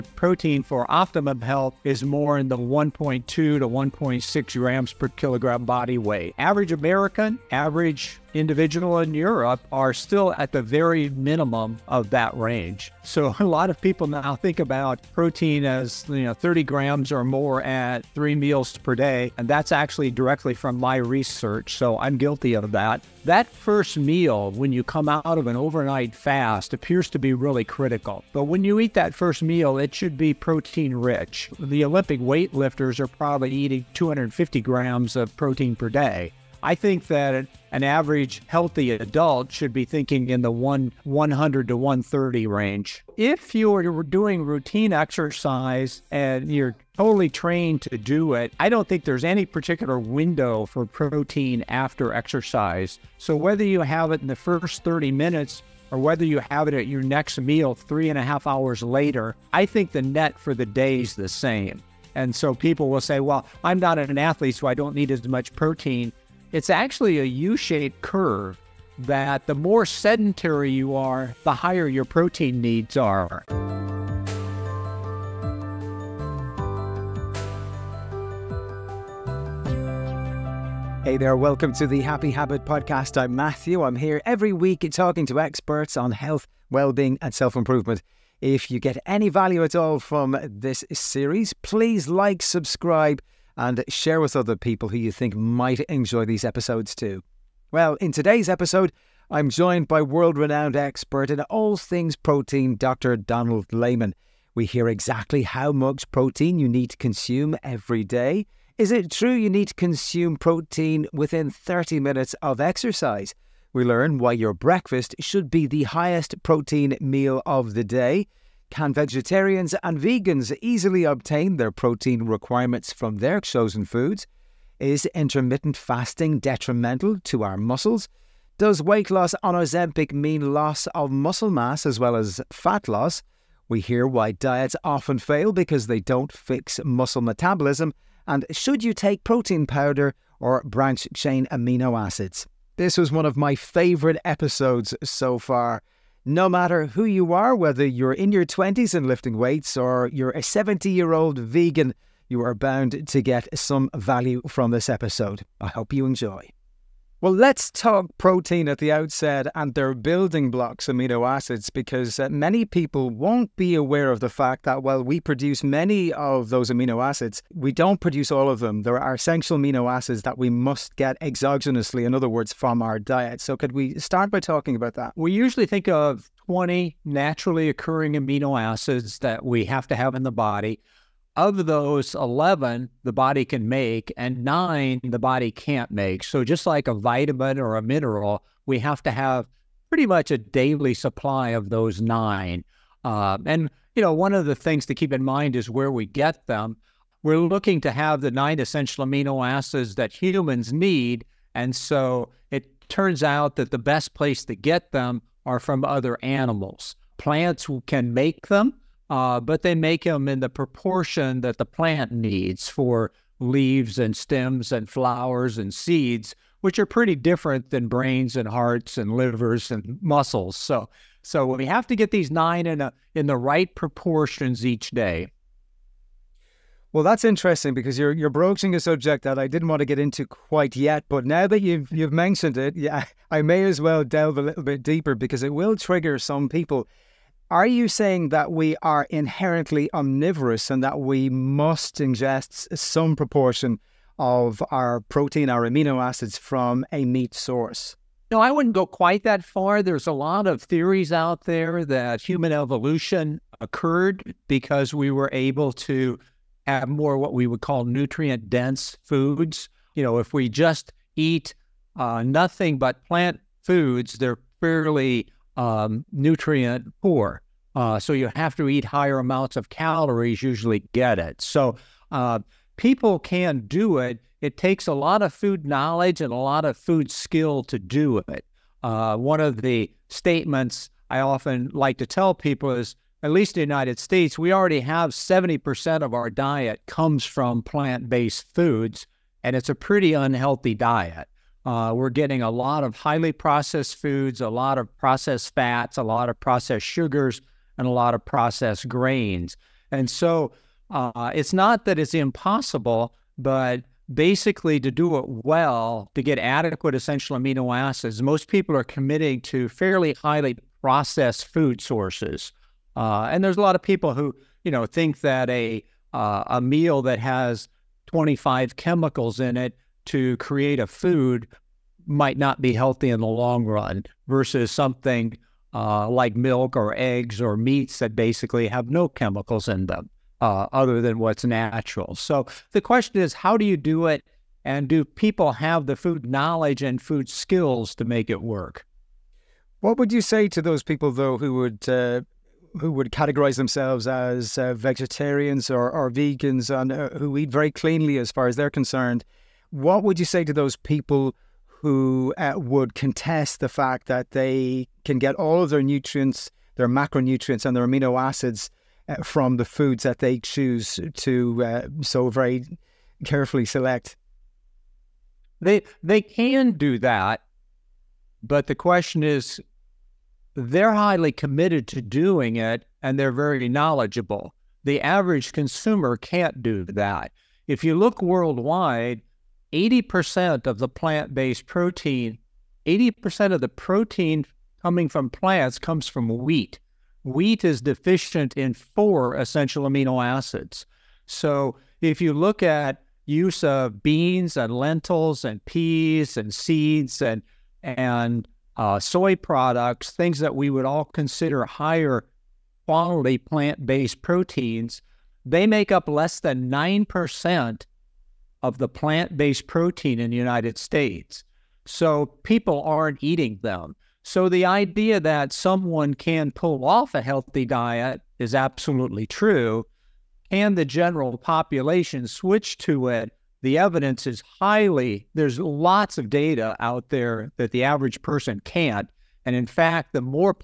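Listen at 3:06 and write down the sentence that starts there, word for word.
So, just like a vitamin or a mineral, we have to have pretty much a daily supply of those nine.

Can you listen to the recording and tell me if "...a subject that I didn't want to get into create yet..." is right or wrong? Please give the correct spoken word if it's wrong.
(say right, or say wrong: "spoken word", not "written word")
wrong: "quite", not "create".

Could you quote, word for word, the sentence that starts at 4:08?
No, I wouldn't go quite that far.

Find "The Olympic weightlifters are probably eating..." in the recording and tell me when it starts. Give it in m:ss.
0:31.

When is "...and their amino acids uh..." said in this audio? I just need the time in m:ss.
5:57.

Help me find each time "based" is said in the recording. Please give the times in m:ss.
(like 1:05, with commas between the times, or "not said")
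4:47, 6:21, 6:43, 6:49.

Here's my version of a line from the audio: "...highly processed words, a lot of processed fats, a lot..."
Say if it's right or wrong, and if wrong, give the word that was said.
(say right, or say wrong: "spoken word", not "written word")
wrong: "foods", not "words".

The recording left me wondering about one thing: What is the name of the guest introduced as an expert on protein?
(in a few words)
Donald Layman.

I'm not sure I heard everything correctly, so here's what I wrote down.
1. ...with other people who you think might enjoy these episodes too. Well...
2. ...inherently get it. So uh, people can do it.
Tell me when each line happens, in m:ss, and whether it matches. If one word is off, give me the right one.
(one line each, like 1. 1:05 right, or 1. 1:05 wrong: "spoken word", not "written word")
1. 1:34 right
2. 4:30 wrong: "usually", not "inherently".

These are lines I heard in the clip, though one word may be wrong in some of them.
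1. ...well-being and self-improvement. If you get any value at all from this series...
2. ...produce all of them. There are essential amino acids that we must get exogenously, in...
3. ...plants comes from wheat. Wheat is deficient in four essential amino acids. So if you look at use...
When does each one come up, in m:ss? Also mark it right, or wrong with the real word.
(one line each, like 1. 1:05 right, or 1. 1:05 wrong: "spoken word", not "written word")
1. 1:26 right
2. 2:47 right
3. 6:25 right.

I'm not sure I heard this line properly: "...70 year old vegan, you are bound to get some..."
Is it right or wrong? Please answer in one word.
right.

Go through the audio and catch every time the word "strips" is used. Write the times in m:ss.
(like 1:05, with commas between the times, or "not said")
not said.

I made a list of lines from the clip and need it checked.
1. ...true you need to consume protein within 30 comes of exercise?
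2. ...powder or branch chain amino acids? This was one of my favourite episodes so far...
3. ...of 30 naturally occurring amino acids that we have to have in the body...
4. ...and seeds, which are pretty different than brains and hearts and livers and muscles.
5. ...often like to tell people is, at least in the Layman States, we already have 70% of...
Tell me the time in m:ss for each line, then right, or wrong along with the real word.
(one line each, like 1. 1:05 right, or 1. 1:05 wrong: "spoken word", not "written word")
1. 1:49 wrong: "minutes", not "comes"
2. 2:19 right
3. 2:55 wrong: "20", not "30"
4. 3:35 right
5. 4:41 wrong: "United", not "Layman".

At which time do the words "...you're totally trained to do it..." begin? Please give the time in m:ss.
0:46.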